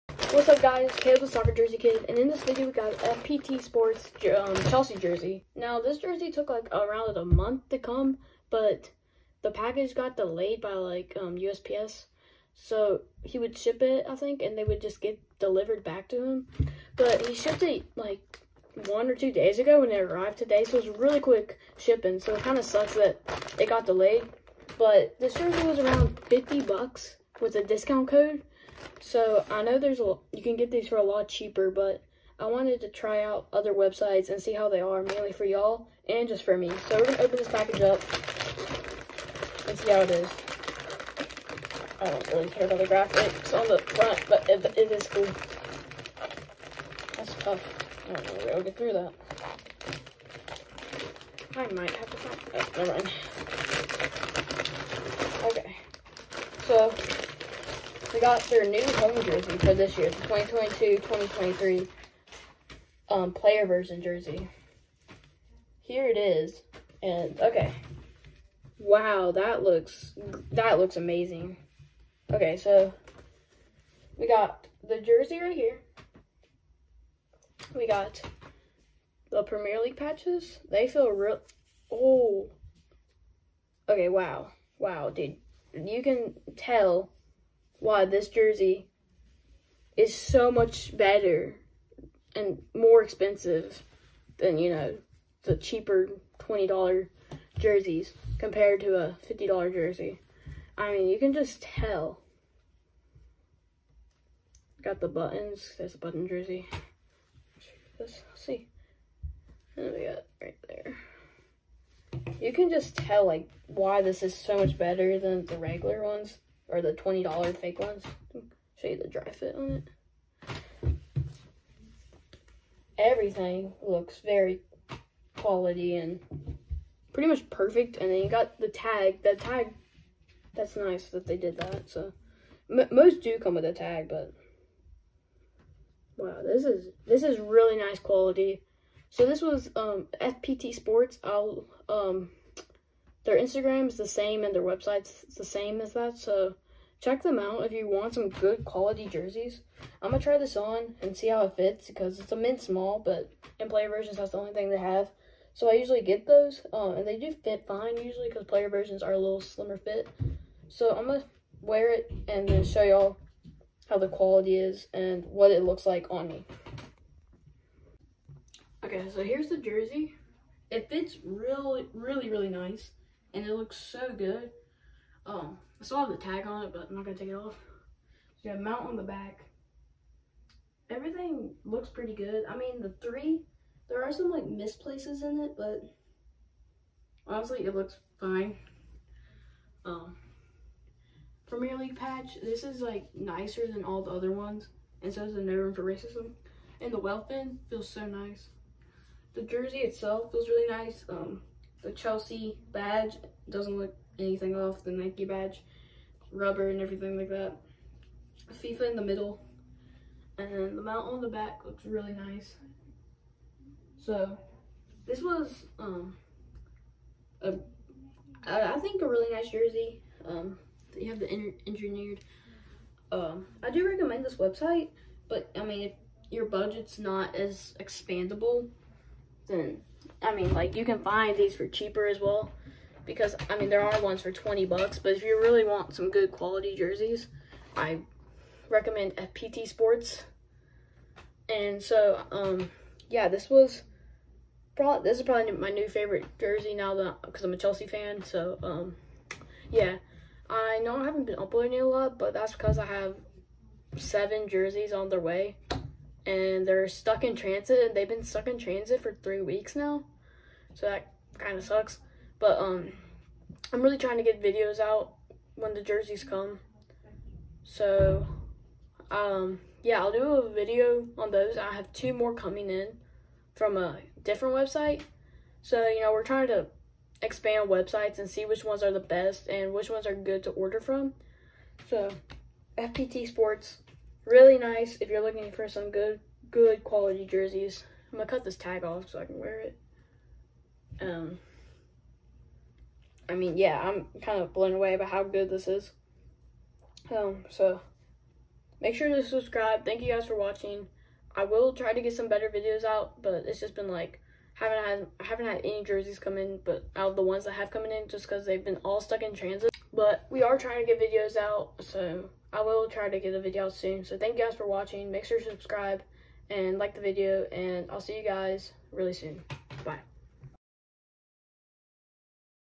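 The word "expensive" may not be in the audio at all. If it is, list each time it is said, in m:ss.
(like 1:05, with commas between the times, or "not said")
1:33.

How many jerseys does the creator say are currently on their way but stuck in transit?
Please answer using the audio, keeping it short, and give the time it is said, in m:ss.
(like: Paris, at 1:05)
seven, at 4:13.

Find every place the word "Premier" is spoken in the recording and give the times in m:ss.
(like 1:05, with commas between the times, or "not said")
1:19, 3:11.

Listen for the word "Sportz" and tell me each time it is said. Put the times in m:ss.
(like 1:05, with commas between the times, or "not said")
0:03, 2:20, 3:59, 4:43.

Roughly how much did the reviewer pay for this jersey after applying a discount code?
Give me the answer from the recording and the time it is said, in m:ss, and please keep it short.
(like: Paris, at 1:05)
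50 bucks, at 0:26.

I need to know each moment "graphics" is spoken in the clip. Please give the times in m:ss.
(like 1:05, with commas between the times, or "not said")
0:42.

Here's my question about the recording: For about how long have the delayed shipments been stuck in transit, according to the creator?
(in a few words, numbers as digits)
three weeks.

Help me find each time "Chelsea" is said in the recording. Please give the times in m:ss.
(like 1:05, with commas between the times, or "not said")
0:04, 3:21, 4:07.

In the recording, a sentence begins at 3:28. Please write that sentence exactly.
FIFA in the middle, and the mount on the back looks really nice.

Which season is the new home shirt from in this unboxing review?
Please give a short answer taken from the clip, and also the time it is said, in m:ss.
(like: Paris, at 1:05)
2022-2023, at 1:00.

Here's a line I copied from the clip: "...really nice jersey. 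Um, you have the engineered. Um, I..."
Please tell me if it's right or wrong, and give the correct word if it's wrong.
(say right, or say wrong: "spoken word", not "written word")
right.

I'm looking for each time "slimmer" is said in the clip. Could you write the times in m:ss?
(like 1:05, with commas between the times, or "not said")
2:39.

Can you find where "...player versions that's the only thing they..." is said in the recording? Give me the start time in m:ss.
2:33.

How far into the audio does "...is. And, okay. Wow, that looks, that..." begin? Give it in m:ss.
1:06.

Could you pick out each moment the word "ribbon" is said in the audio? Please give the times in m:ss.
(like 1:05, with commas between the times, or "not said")
not said.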